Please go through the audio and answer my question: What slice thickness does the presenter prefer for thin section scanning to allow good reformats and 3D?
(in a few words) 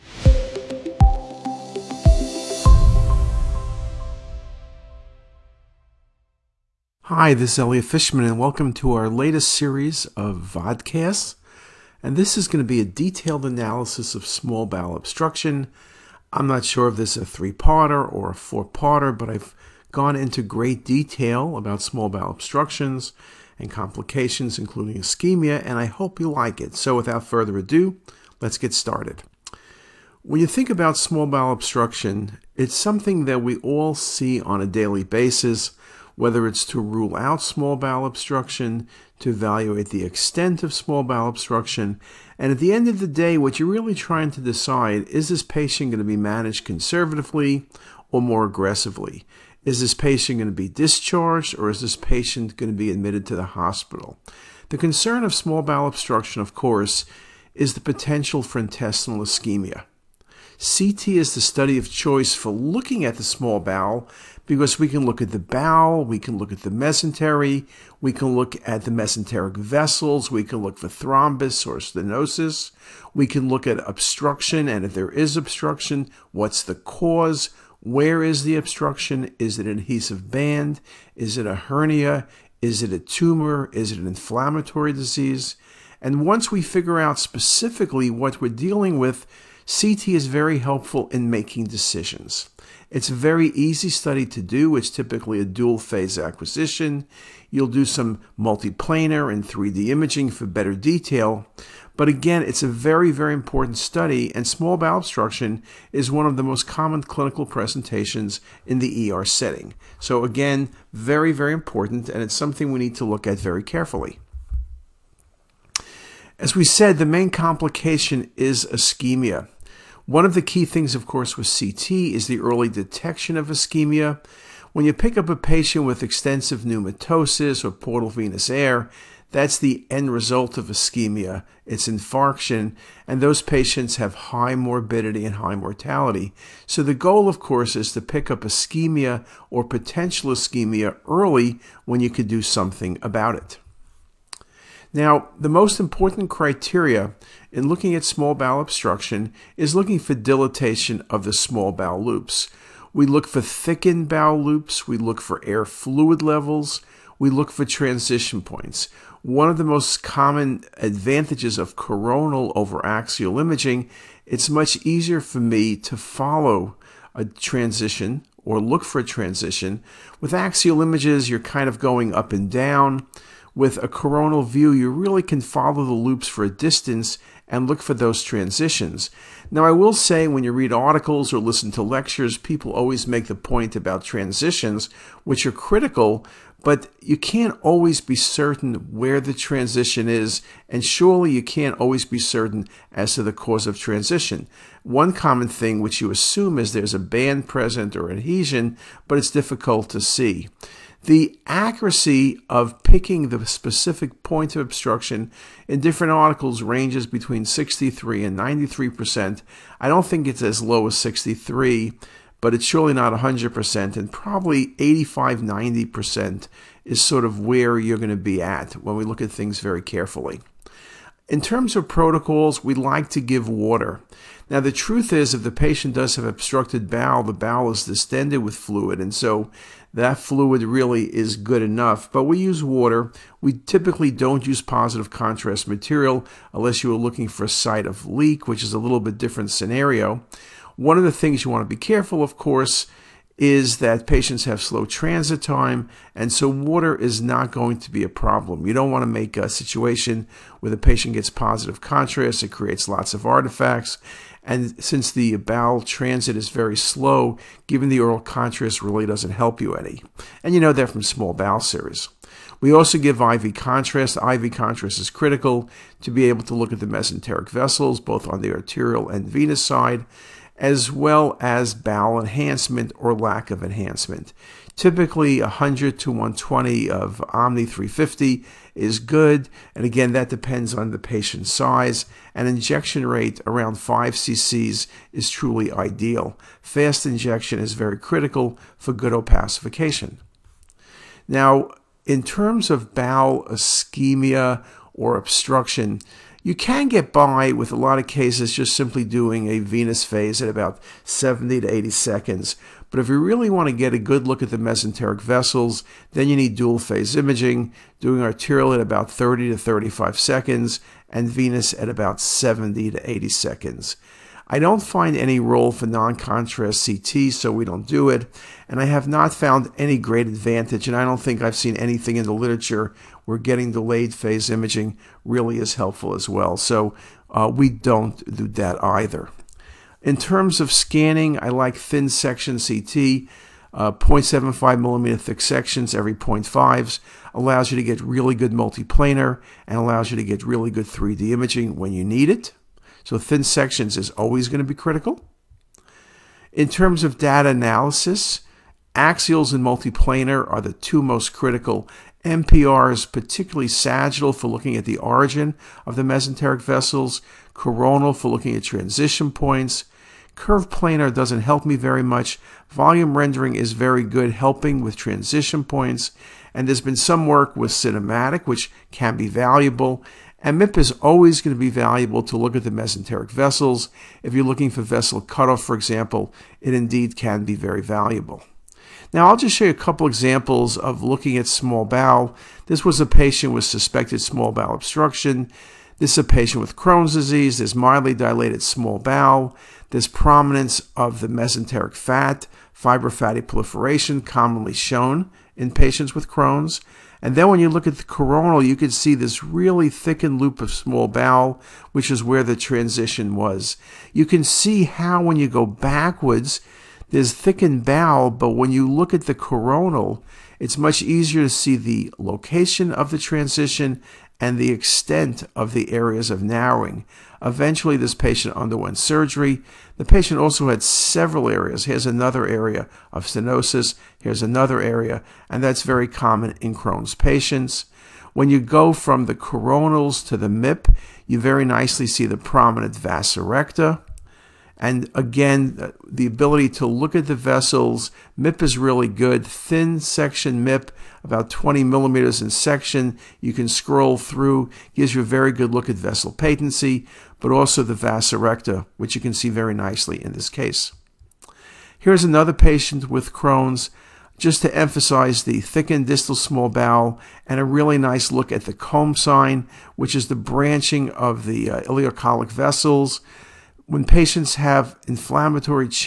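0.75 millimeter.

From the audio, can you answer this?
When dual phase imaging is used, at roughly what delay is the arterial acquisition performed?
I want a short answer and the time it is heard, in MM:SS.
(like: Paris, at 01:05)
30 to 35 seconds, at 05:09.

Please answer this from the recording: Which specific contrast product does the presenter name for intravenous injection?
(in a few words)
Omni 350.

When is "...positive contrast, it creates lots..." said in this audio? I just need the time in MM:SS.
04:11.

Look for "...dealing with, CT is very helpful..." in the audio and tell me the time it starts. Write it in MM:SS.
01:28.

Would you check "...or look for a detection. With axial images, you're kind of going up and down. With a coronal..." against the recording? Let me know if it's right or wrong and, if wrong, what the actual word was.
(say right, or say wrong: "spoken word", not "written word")
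wrong: "transition", not "detection".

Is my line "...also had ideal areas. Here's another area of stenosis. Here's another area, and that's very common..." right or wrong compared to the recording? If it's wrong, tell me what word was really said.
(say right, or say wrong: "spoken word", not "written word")
wrong: "several", not "ideal".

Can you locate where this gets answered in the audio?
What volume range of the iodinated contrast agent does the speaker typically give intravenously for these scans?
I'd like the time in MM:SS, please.
04:35.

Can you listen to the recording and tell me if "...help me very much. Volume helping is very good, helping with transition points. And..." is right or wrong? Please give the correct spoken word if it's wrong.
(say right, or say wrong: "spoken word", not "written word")
wrong: "rendering", not "helping".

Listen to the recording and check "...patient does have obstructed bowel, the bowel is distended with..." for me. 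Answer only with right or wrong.
right.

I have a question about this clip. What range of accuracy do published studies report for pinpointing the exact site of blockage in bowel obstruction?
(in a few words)
63 to 93%.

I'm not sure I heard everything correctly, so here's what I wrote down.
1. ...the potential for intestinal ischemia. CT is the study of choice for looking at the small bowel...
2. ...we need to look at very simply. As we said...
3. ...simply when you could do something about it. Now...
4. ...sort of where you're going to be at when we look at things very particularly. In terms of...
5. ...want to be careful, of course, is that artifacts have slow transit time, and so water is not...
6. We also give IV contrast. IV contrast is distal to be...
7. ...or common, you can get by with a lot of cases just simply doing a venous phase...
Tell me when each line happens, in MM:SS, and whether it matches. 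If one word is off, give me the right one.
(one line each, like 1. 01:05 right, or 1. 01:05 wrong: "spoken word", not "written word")
1. 00:57 right
2. 01:52 wrong: "carefully", not "simply"
3. 02:21 wrong: "early", not "simply"
4. 03:37 wrong: "carefully", not "particularly"
5. 04:01 wrong: "patients", not "artifacts"
6. 04:22 wrong: "critical", not "distal"
7. 04:54 wrong: "obstruction", not "common".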